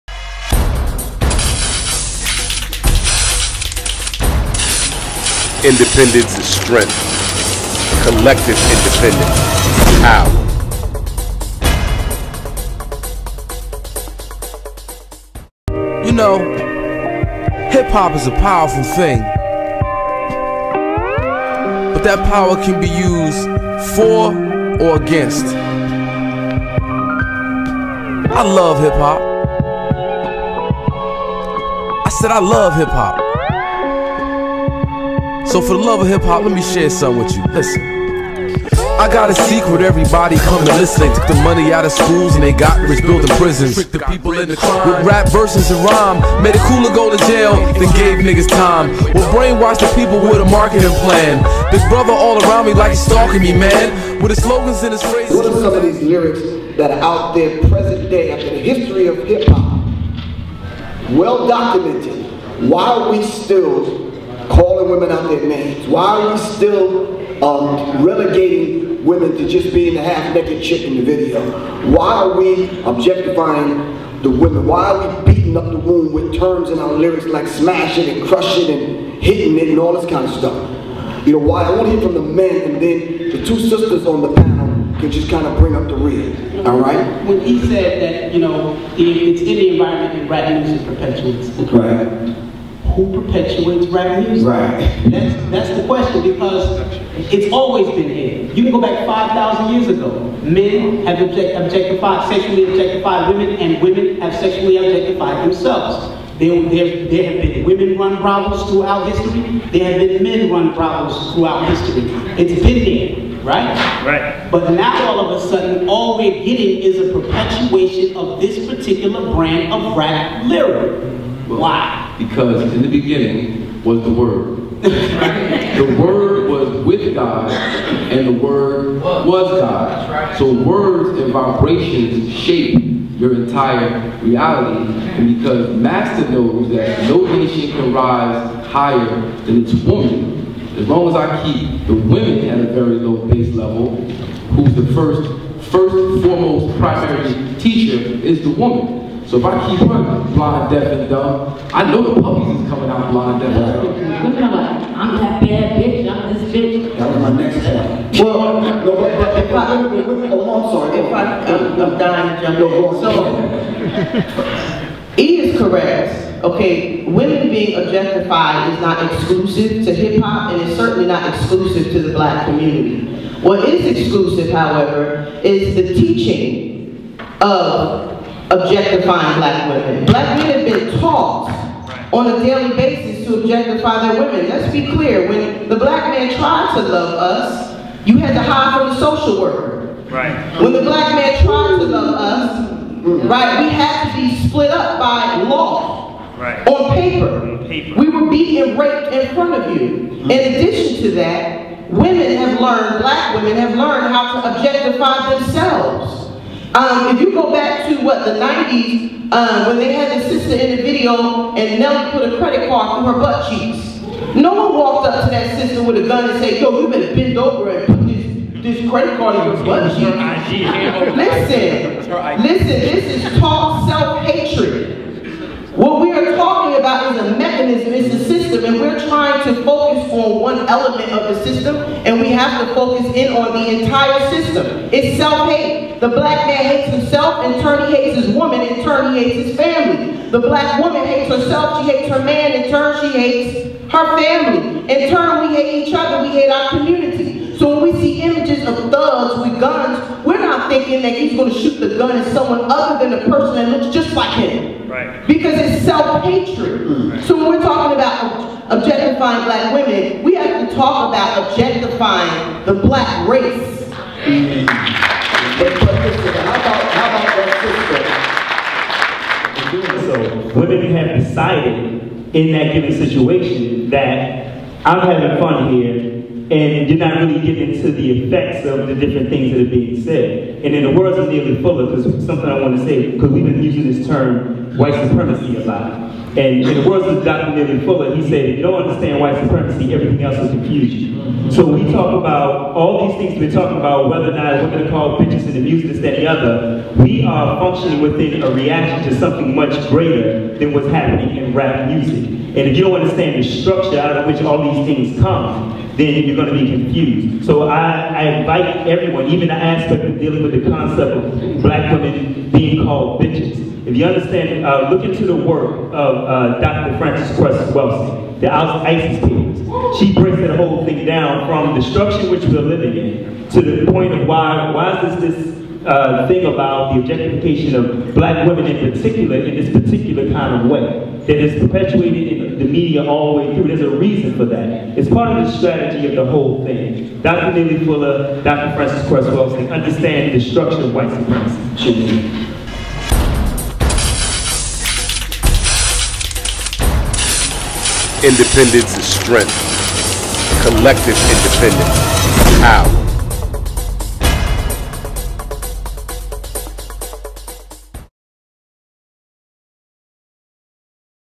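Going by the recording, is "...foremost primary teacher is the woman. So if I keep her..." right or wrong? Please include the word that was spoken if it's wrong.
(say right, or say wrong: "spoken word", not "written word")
right.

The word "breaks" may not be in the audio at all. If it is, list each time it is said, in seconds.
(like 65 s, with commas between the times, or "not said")
320 s.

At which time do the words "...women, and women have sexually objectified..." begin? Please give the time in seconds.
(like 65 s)
103 s.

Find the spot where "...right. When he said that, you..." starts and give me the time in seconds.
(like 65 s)
86 s.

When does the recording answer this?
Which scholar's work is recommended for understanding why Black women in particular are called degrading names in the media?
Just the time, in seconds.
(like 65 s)
316 s.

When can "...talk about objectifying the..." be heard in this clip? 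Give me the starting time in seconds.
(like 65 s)
260 s.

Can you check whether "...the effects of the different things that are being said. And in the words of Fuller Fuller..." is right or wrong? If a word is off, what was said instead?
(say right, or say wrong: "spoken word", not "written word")
wrong: "Neely", not "Fuller".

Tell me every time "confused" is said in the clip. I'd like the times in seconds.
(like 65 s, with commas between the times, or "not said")
290 s, 306 s.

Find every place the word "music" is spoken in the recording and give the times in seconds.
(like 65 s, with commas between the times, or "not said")
94 s, 295 s, 301 s.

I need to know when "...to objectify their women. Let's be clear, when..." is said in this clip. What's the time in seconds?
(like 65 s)
183 s.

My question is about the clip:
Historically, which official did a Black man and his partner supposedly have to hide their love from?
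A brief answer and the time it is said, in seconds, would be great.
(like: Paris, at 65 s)
The social worker, at 188 s.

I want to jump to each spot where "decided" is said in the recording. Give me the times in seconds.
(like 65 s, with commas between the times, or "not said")
271 s.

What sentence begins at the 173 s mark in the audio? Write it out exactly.
What is exclusive, however, is the teaching of objectifying black women.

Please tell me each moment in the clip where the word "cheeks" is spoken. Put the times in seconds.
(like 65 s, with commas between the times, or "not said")
213 s, 219 s.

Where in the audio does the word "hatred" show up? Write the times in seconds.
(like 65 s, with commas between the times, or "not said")
223 s, 255 s.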